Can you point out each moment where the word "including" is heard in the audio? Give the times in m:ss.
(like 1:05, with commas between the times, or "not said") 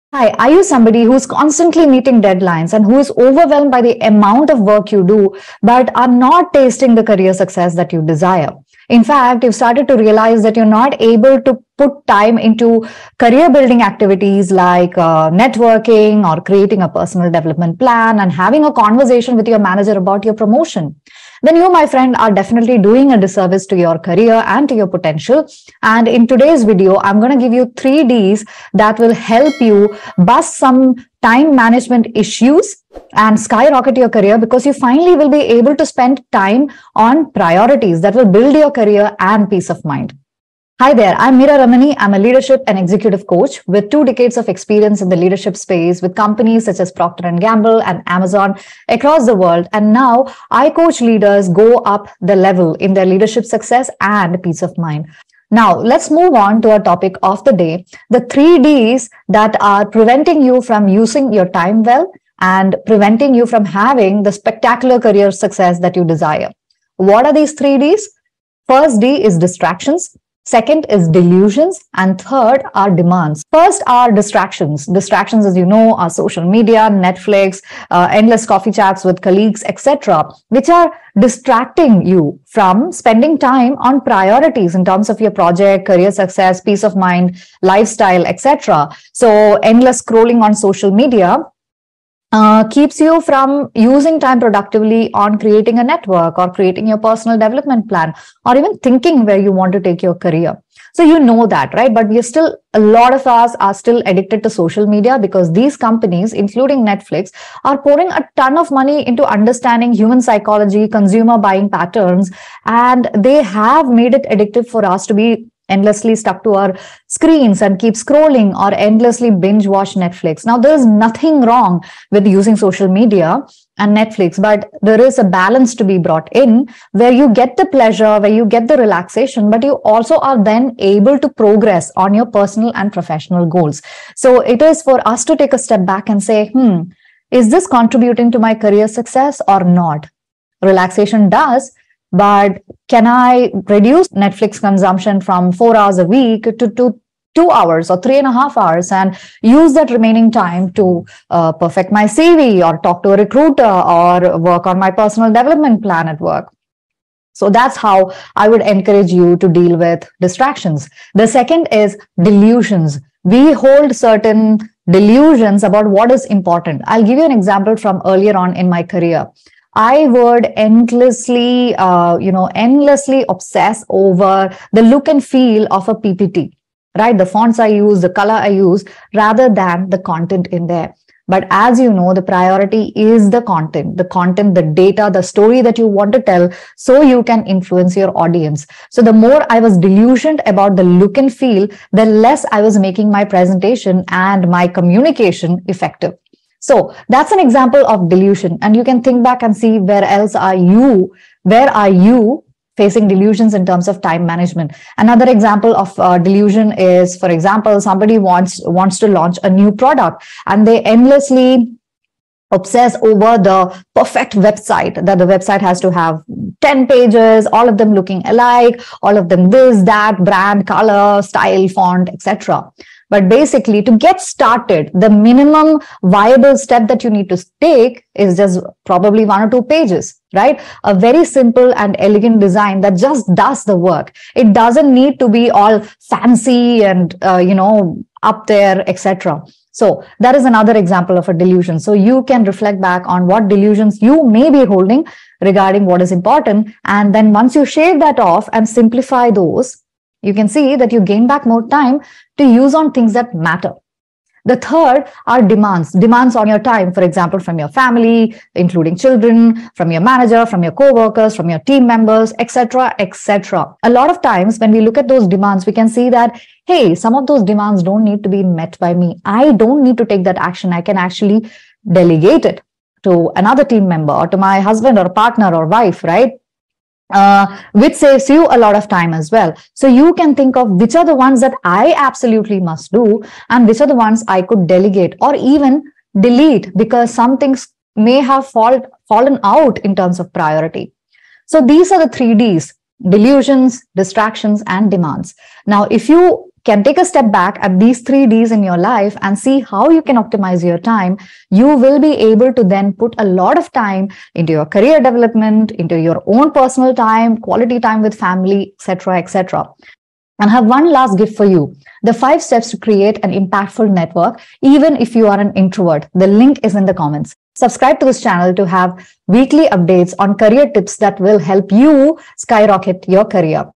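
1:46, 4:18.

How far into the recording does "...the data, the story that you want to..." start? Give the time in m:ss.
3:04.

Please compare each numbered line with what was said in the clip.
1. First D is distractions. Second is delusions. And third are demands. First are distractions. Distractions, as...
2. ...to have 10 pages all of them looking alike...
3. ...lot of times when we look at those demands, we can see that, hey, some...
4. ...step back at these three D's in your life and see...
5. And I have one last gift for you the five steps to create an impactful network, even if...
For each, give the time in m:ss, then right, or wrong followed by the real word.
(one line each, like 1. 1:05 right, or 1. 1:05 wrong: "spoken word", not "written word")
1. 1:08 right
2. 3:35 right
3. 4:23 right
4. 4:57 right
5. 5:10 right.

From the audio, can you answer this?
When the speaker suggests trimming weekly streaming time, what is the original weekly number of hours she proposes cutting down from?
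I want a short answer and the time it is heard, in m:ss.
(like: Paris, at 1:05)
4 hours, at 2:25.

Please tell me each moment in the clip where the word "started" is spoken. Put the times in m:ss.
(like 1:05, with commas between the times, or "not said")
0:09, 3:44.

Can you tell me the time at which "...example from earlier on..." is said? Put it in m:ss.
2:47.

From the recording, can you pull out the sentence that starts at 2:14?
So it is for us to take a step back and say, hmm, is this contributing to my career success or not?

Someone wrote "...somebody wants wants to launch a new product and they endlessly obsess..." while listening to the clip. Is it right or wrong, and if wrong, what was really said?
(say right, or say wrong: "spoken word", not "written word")
right.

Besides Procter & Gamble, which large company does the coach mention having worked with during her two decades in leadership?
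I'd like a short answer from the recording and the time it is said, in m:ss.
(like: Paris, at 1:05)
Amazon, at 0:48.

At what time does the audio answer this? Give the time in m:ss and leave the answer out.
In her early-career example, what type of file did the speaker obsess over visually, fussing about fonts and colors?
2:55.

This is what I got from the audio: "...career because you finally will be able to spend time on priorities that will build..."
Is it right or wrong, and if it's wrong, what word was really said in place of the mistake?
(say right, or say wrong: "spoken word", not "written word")
right.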